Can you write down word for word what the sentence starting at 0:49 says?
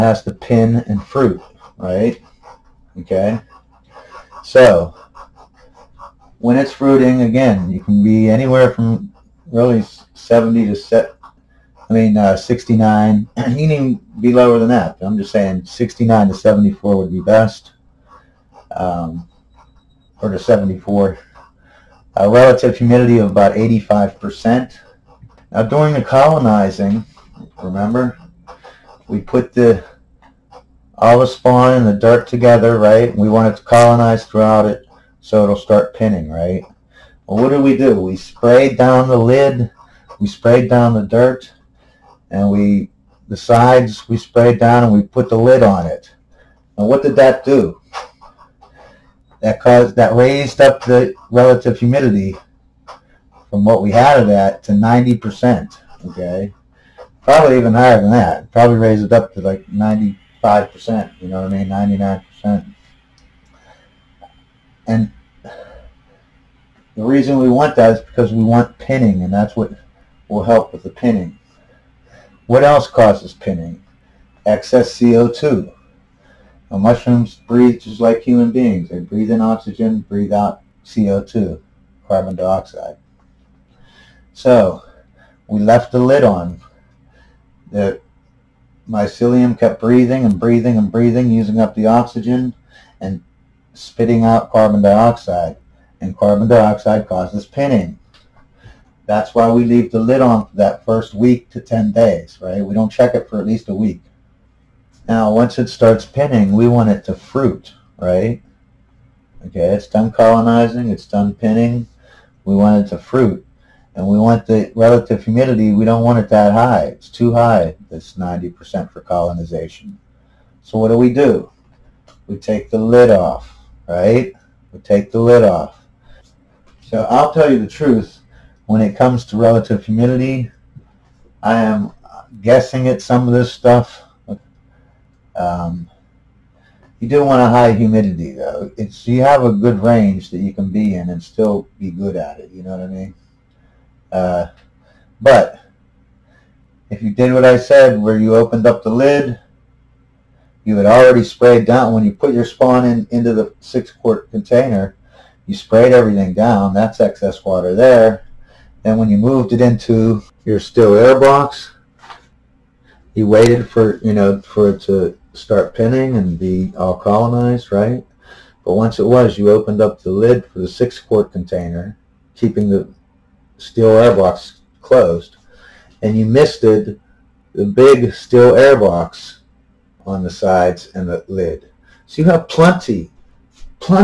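that caused that raised up the relative humidity from what we had of that to 90%.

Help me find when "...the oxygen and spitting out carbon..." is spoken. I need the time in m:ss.
1:31.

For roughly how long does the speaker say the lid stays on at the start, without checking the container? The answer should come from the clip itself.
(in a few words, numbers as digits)
A week to 10 days.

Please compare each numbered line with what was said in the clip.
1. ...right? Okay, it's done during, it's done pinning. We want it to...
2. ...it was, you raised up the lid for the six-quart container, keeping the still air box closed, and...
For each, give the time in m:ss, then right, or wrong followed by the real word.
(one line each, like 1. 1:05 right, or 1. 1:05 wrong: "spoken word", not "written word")
1. 1:47 wrong: "colonizing", not "during"
2. 2:48 wrong: "opened", not "raised".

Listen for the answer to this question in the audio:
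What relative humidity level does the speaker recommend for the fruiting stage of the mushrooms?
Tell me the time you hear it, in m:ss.
0:23.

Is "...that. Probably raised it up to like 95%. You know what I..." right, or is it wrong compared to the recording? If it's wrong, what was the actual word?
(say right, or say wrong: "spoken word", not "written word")
right.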